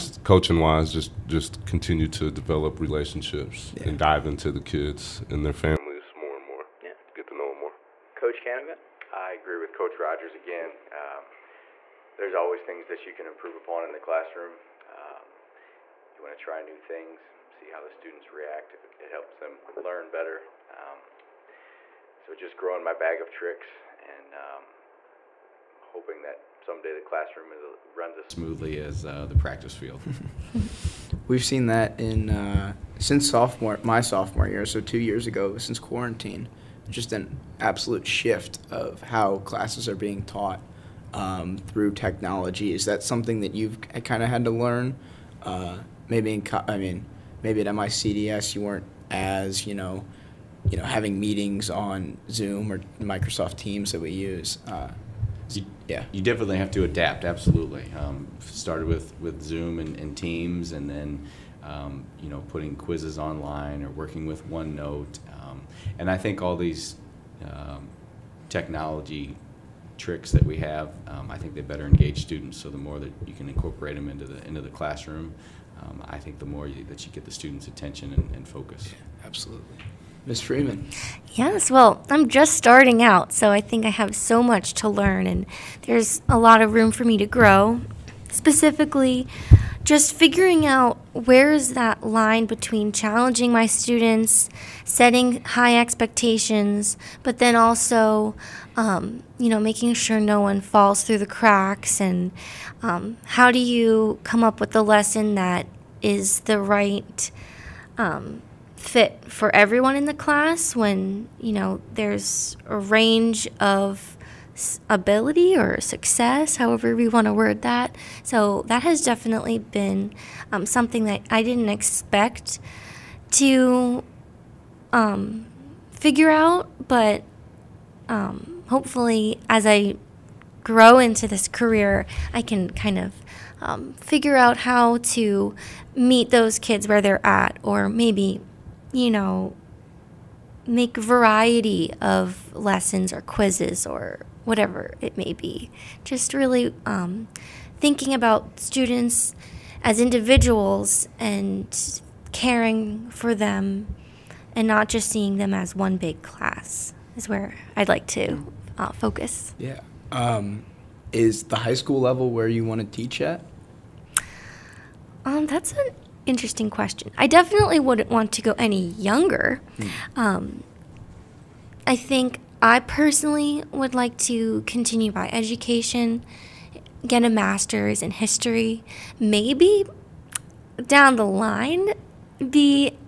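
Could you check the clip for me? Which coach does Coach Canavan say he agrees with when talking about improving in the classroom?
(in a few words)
Coach Rodgers.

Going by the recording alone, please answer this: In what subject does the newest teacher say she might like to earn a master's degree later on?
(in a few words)
History.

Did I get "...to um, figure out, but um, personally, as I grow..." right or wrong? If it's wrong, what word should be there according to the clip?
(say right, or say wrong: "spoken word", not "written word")
wrong: "hopefully", not "personally".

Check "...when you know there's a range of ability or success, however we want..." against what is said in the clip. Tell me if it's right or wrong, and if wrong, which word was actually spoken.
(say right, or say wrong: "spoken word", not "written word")
right.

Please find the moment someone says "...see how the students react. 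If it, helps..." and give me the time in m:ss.
0:17.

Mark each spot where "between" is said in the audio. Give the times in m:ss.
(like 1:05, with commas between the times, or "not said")
1:32.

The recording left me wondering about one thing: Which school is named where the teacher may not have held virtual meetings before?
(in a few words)
MICDS.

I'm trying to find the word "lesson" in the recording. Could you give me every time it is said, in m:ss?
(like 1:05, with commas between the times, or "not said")
1:44, 2:22.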